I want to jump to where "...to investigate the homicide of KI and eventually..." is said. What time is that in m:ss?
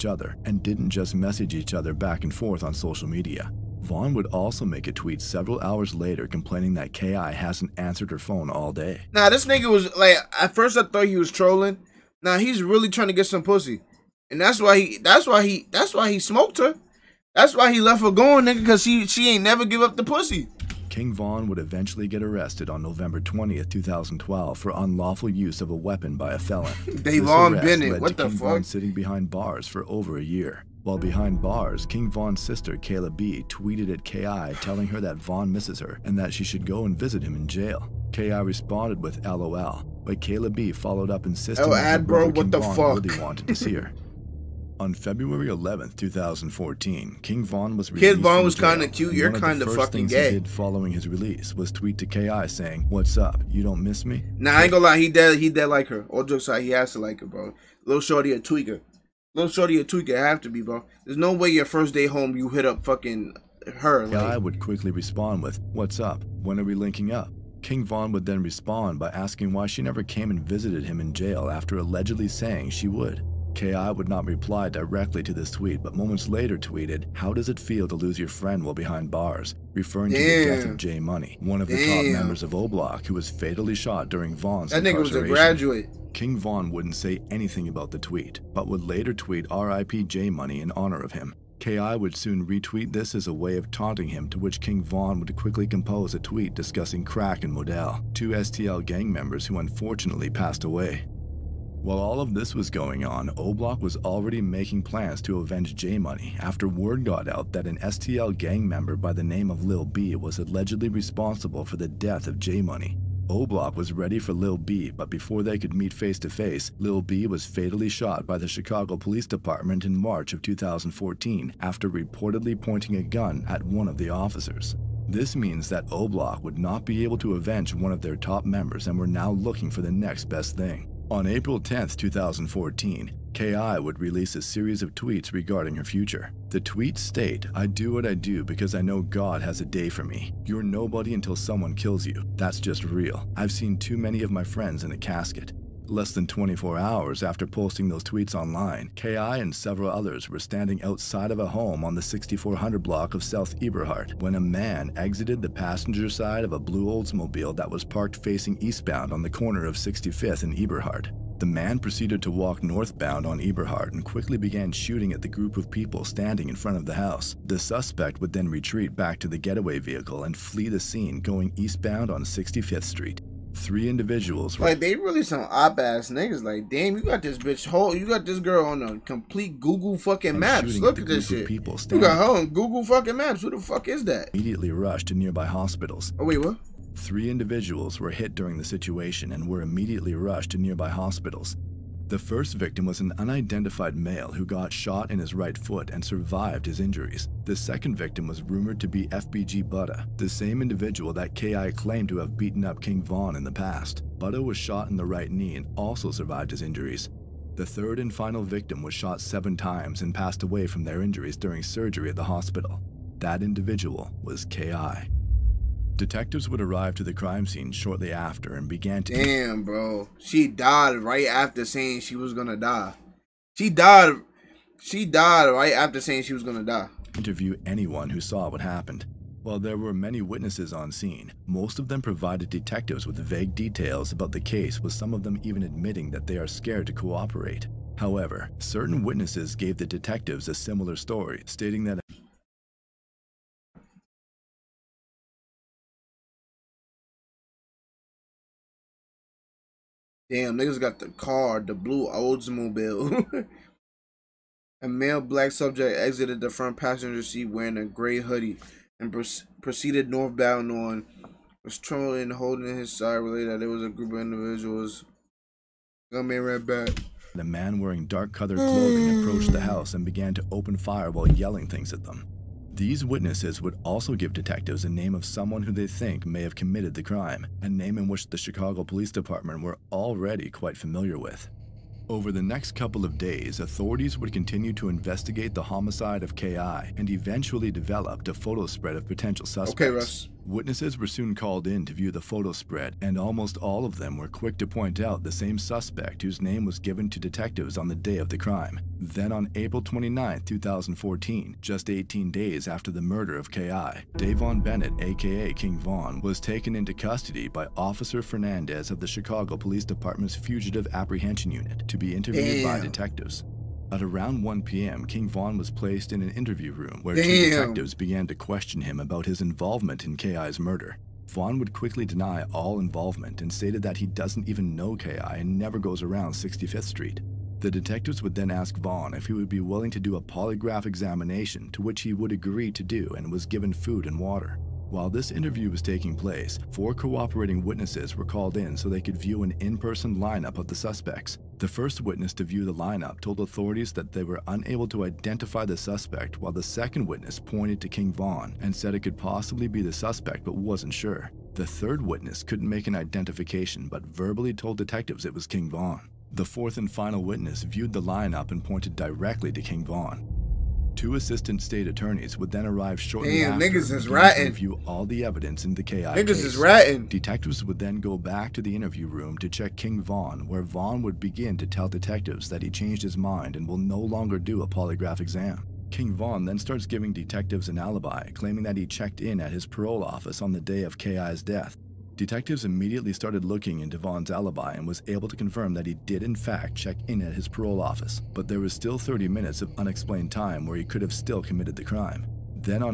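4:44.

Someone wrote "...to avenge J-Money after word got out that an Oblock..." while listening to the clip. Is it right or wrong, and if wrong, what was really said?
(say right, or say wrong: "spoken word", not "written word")
wrong: "STL", not "Oblock".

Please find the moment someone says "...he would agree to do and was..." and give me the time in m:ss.
5:32.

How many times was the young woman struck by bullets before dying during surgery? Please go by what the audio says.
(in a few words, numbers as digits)
7.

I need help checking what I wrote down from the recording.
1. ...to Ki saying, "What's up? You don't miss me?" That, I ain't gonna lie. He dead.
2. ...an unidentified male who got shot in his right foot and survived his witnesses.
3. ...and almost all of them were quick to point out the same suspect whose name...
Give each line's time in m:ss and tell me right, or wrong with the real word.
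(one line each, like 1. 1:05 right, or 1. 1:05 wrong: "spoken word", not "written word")
1. 0:51 wrong: "Nah", not "That"
2. 3:13 wrong: "injuries", not "witnesses"
3. 4:53 right.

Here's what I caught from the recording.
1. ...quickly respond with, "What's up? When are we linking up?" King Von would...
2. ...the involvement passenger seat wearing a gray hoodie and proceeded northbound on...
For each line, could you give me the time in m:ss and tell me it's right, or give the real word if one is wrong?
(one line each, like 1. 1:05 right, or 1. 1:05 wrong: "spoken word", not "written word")
1. 1:04 right
2. 4:16 wrong: "front", not "involvement".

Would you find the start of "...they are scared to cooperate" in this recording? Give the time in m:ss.
3:56.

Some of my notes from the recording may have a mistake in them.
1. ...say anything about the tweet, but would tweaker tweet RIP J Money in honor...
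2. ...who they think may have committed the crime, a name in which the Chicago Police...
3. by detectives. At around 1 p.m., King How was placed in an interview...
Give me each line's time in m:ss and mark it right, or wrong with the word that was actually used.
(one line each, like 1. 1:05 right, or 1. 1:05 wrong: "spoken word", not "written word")
1. 1:26 wrong: "later", not "tweaker"
2. 4:35 right
3. 5:12 wrong: "Von", not "How".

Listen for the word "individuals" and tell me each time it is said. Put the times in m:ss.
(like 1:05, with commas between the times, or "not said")
2:53, 3:07, 3:20, 3:33, 4:24.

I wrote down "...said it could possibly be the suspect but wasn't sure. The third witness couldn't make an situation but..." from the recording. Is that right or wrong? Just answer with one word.
wrong.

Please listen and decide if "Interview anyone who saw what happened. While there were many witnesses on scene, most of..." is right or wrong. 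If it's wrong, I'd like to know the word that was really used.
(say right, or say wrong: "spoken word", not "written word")
right.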